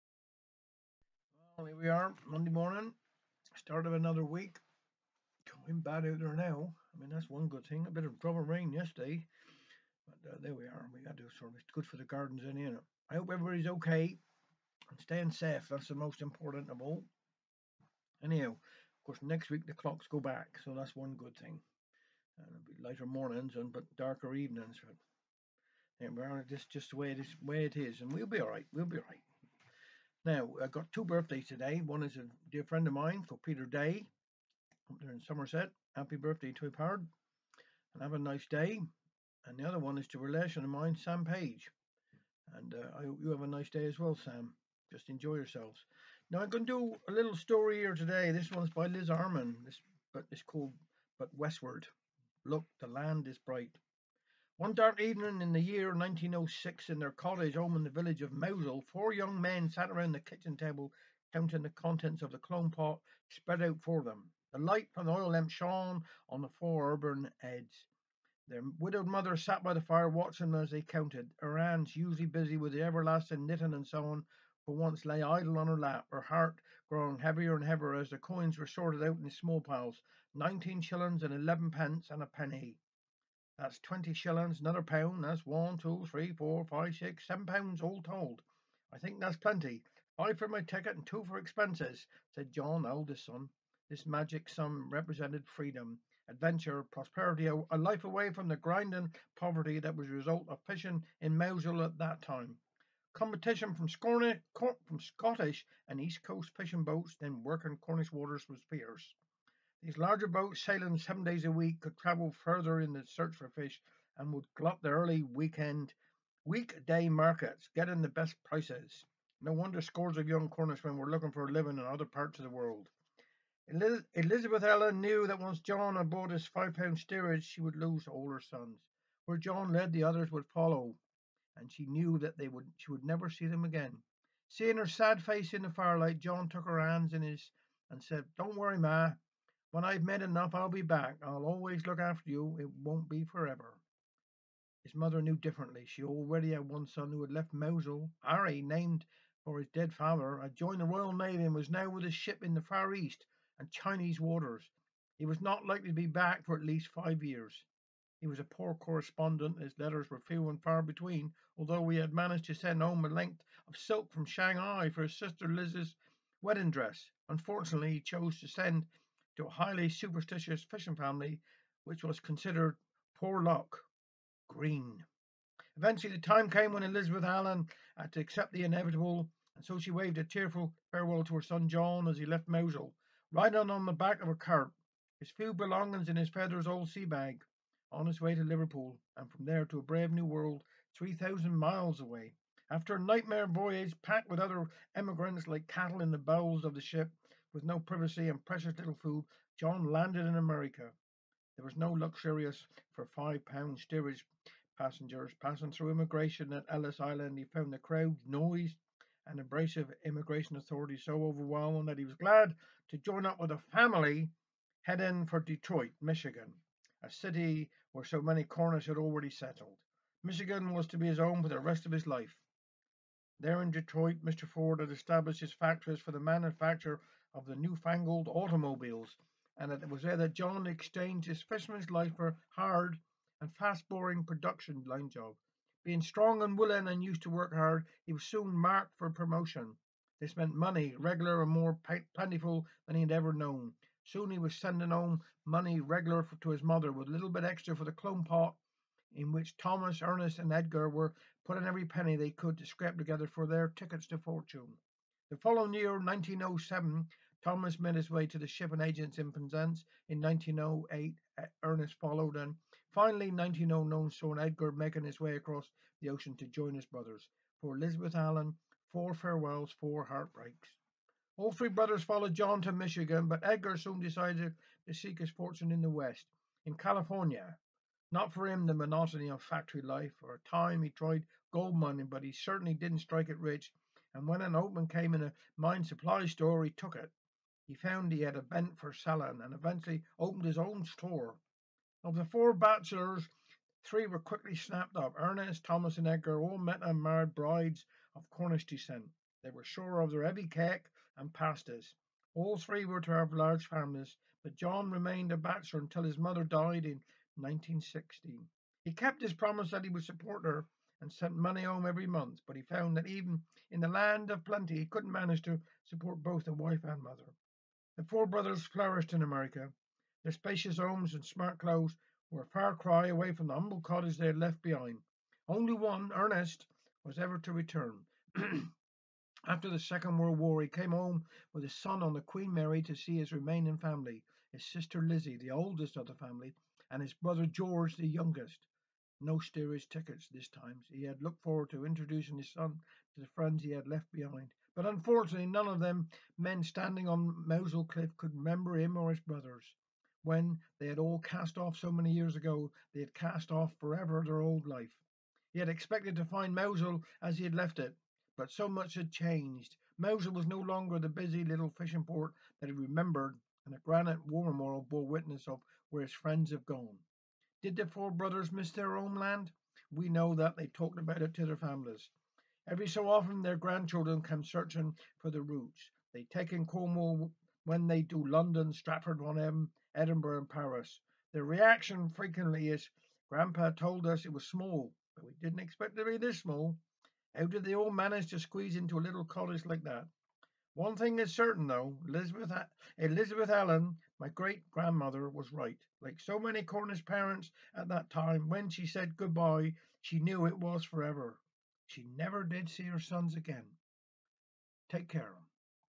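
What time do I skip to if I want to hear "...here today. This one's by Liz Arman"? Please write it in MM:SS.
00:47.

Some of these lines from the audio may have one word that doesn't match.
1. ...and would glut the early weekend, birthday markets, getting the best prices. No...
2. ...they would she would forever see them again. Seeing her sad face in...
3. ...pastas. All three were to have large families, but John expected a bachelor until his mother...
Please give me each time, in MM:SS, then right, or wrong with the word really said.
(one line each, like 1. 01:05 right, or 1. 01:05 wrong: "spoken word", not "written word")
1. 01:54 wrong: "weekday", not "birthday"
2. 02:12 wrong: "never", not "forever"
3. 05:01 wrong: "remained", not "expected".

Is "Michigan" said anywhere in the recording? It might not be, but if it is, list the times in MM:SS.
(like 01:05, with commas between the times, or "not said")
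03:35, 03:40, 04:32.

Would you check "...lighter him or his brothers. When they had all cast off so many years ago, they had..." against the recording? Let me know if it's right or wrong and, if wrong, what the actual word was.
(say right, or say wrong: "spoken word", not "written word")
wrong: "remember", not "lighter".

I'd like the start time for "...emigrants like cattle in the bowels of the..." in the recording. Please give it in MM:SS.
03:14.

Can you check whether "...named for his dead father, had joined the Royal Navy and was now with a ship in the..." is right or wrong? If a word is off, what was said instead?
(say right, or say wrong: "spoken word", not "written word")
right.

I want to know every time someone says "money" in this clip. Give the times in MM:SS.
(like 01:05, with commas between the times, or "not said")
04:00, 04:05, 05:11.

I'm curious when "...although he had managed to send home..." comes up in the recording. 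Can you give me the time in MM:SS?
02:41.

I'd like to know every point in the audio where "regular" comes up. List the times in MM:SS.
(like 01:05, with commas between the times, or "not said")
04:00, 04:05.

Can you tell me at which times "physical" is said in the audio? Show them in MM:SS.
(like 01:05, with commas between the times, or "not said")
not said.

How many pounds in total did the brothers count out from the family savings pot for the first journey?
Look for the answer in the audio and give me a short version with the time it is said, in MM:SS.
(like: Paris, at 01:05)
7 pounds, at 01:27.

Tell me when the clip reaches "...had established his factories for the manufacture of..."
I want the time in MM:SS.
03:44.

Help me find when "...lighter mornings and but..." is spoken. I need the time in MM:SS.
00:22.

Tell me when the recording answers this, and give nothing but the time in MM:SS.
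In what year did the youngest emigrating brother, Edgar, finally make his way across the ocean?
04:23.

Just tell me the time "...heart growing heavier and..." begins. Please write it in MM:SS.
01:16.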